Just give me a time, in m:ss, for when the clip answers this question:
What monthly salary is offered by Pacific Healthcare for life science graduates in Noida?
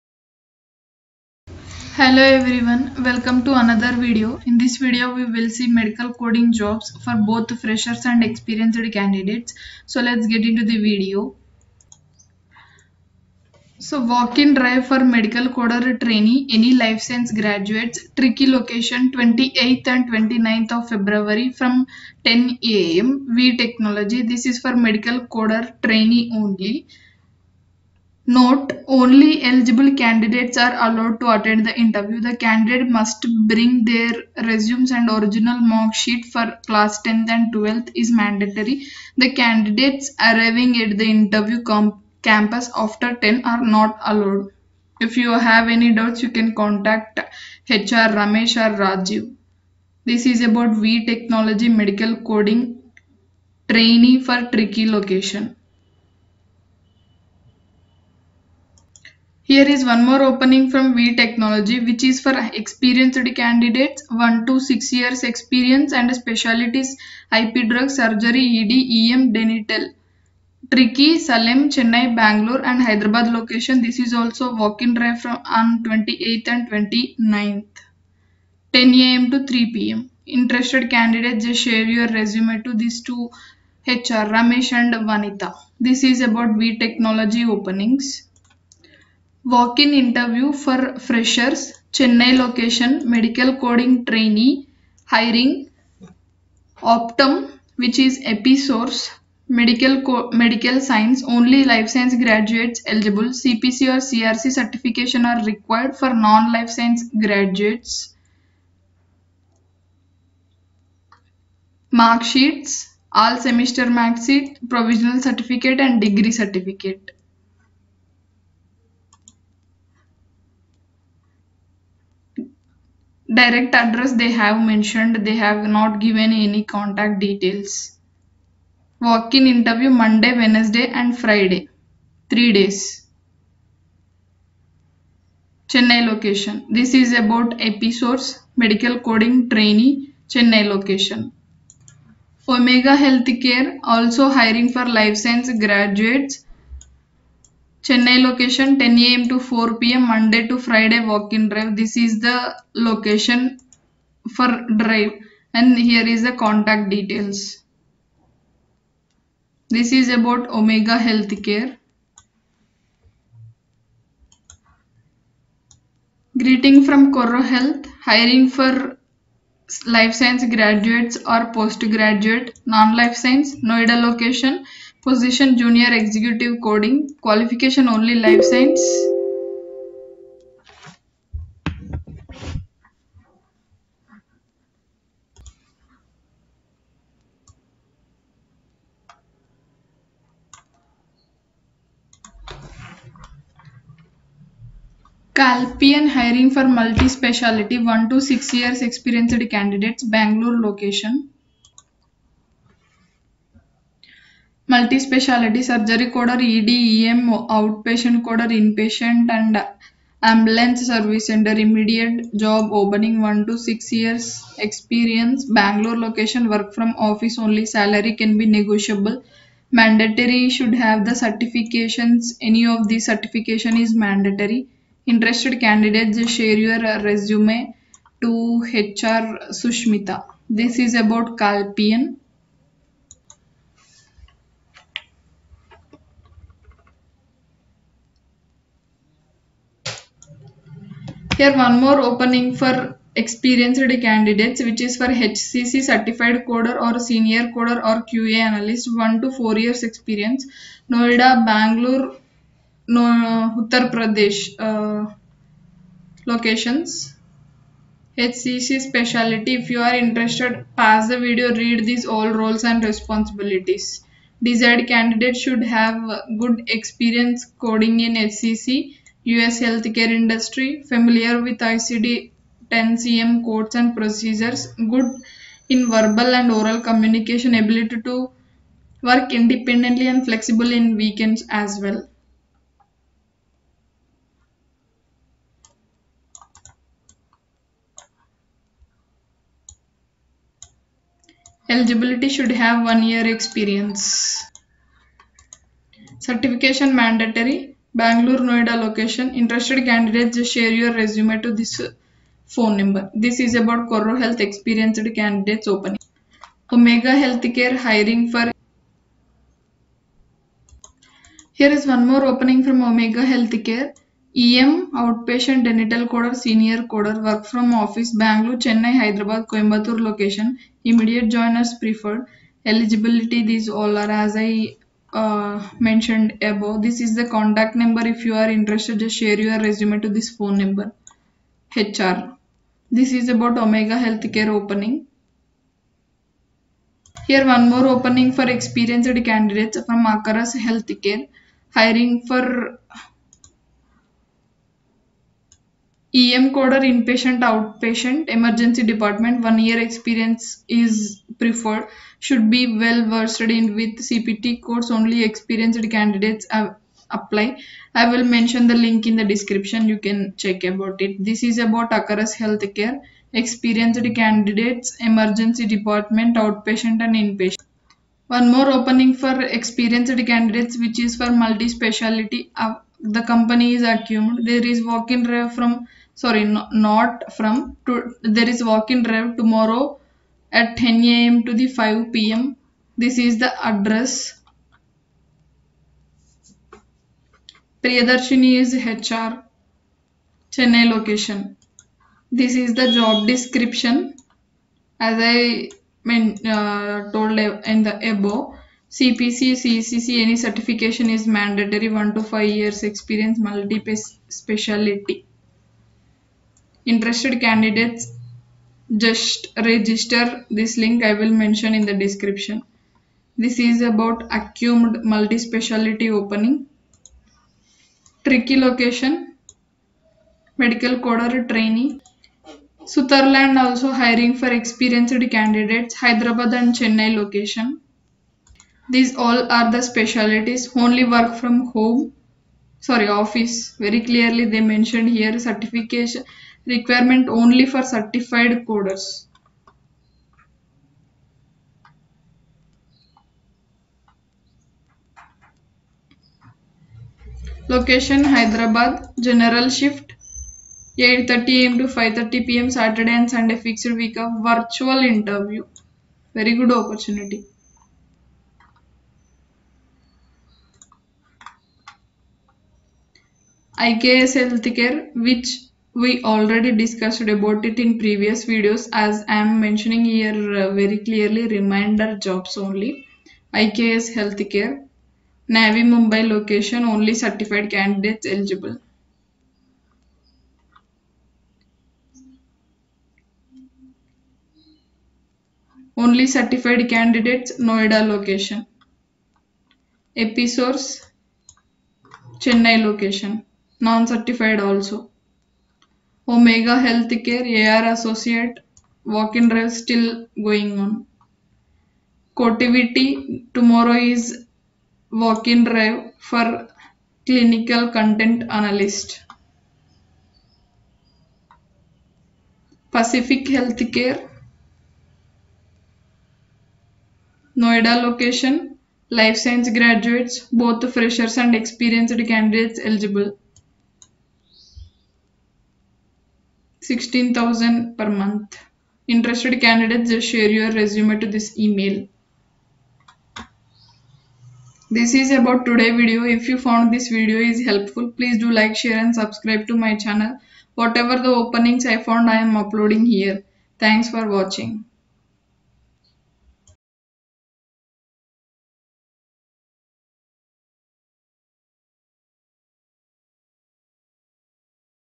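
8:46.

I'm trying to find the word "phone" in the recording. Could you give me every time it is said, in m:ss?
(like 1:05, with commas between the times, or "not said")
5:02, 5:30.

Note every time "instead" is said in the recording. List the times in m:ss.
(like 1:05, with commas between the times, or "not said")
not said.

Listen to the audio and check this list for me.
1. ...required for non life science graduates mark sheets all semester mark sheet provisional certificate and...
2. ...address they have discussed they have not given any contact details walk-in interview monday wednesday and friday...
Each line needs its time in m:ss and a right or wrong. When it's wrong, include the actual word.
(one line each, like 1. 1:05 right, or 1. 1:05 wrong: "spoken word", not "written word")
1. 1:45 right
2. 2:03 wrong: "mentioned", not "discussed".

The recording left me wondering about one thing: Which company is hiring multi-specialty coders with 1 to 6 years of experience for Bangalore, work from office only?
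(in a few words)
Calpian.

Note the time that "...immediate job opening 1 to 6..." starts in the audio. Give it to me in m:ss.
3:31.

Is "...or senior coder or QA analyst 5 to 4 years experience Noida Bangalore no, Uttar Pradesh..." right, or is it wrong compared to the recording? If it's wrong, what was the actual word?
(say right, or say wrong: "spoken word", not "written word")
wrong: "1", not "5".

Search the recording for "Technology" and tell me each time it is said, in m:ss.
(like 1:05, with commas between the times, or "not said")
0:23, 0:51, 1:01, 1:26.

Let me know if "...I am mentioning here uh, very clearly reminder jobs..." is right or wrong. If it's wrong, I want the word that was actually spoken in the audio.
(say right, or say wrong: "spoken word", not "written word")
right.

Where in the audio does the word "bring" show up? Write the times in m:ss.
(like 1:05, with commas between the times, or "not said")
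0:33.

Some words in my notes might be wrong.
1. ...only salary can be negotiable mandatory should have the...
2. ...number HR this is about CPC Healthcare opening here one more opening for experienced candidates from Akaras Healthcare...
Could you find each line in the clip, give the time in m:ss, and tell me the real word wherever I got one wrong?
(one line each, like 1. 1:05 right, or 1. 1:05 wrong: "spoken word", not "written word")
1. 3:37 right
2. 5:30 wrong: "Omega", not "CPC".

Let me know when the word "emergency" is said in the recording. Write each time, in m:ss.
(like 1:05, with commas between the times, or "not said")
5:48, 6:04.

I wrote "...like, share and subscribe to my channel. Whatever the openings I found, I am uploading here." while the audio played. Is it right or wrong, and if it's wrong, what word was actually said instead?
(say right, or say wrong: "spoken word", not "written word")
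right.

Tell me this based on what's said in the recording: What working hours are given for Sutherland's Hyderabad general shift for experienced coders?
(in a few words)
8:30 am to 5:30 pm.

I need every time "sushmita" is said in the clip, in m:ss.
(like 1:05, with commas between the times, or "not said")
3:49.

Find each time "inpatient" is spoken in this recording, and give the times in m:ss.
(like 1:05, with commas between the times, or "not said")
3:28, 5:46, 6:07.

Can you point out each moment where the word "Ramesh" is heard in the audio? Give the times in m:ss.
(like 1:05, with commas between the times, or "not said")
0:48, 1:24.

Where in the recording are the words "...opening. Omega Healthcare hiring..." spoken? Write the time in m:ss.
5:05.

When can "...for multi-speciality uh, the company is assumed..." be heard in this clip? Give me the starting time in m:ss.
6:11.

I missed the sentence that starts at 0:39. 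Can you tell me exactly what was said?
The candidates arriving at the interview campus after 10 are not allowed.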